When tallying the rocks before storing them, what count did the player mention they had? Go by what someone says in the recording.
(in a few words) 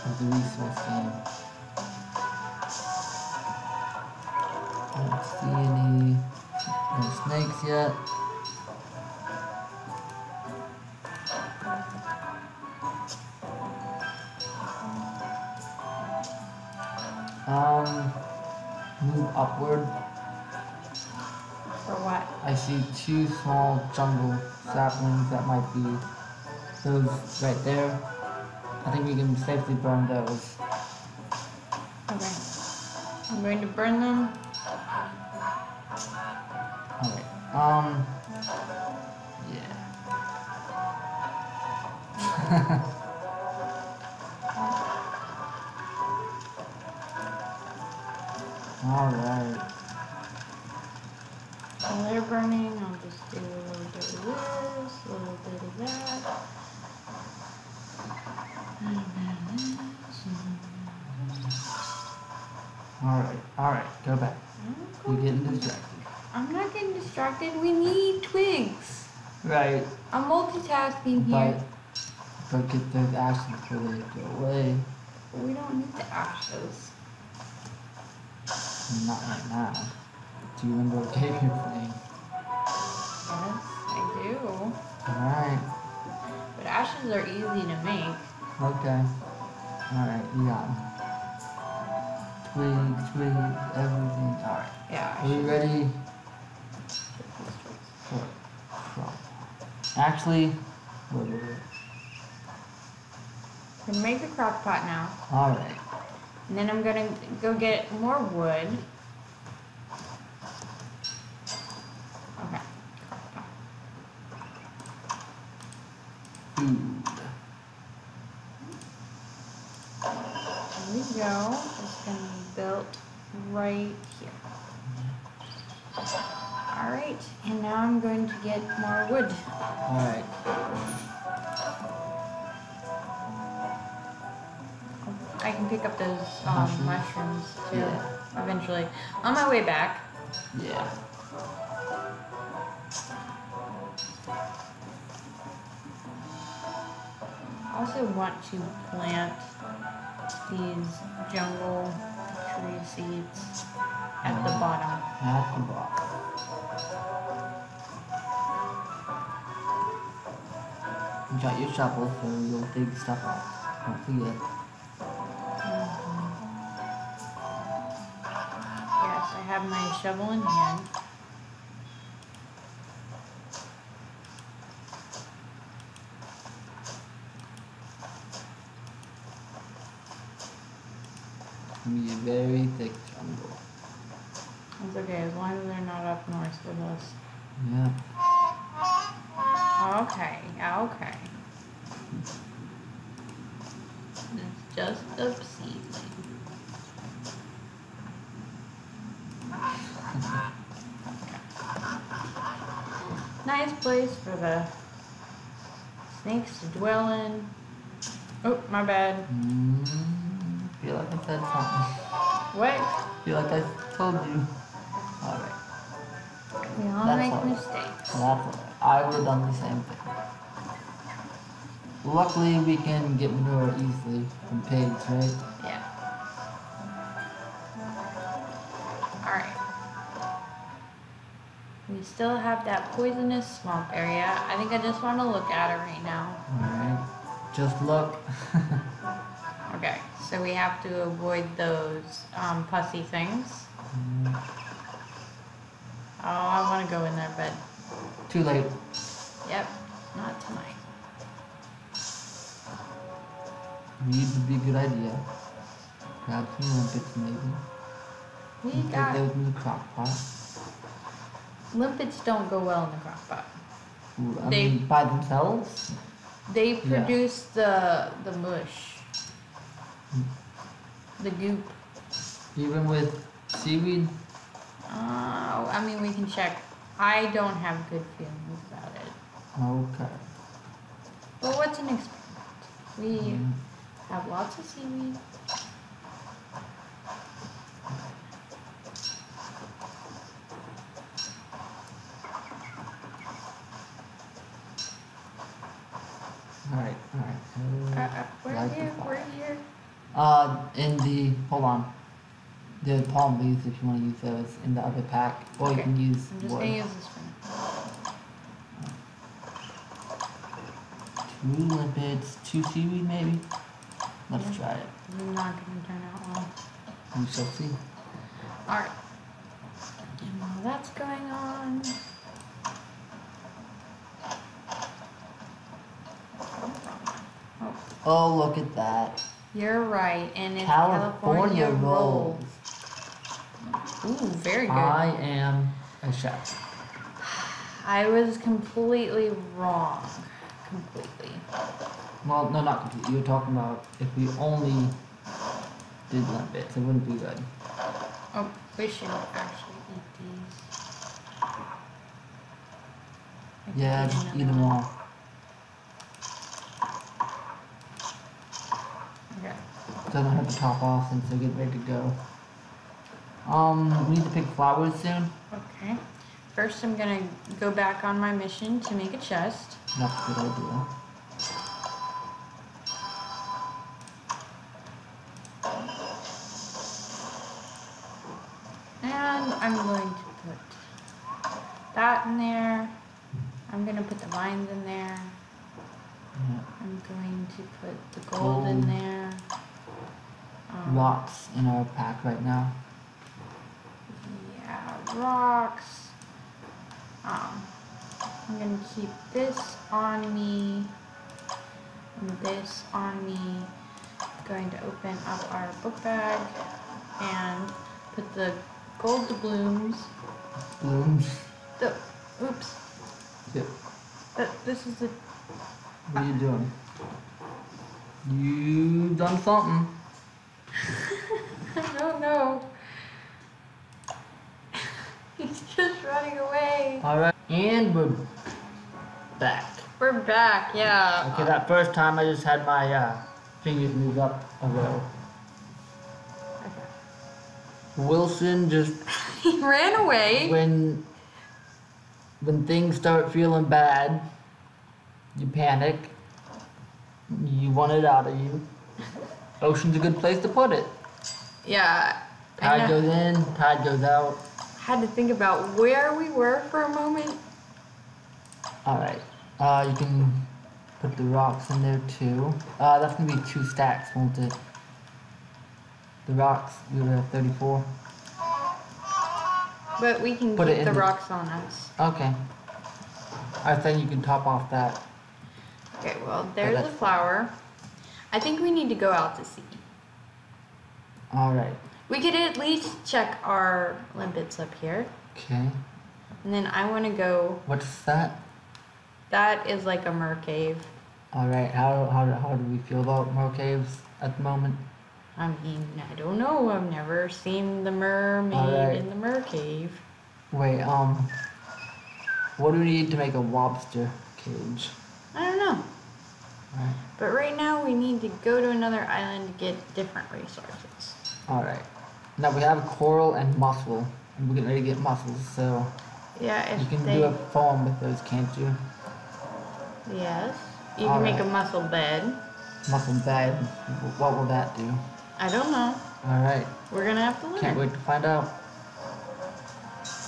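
34.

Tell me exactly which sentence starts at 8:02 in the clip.
We could at least check our limpets up here.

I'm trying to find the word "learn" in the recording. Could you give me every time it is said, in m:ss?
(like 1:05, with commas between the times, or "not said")
8:47.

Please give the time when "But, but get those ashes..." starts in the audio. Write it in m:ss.
1:12.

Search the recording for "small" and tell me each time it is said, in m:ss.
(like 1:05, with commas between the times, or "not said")
0:23.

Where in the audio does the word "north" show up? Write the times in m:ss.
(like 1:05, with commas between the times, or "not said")
3:06.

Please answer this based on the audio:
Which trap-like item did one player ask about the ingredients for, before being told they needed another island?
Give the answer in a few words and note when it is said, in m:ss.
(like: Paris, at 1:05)
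Lobster cage, at 8:23.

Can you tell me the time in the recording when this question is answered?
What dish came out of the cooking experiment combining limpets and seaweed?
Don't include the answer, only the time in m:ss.
5:31.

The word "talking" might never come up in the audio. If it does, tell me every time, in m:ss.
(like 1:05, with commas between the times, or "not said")
5:43.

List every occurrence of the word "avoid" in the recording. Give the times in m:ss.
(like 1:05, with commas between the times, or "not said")
4:01.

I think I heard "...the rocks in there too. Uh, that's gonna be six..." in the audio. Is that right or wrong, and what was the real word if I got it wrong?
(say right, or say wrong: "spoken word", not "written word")
wrong: "two", not "six".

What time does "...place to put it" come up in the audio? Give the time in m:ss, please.
7:30.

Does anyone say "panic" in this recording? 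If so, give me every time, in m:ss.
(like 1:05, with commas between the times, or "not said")
7:25.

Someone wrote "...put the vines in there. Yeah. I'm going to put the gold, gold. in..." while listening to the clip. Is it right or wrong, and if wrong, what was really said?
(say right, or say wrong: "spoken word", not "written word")
right.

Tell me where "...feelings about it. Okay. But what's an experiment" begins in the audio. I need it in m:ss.
4:38.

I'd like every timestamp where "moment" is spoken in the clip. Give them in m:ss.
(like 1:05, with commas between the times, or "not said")
7:36, 8:14.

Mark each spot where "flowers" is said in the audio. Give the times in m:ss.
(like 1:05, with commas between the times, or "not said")
6:04, 7:56.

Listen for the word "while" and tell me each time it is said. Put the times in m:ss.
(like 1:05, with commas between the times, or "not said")
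0:51, 5:20.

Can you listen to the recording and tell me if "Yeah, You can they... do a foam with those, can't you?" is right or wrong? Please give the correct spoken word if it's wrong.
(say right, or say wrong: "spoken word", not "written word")
right.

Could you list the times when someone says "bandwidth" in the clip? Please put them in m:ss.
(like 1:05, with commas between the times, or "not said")
not said.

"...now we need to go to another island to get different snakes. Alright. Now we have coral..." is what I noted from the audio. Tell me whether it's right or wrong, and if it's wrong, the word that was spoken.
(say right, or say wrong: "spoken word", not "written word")
wrong: "resources", not "snakes".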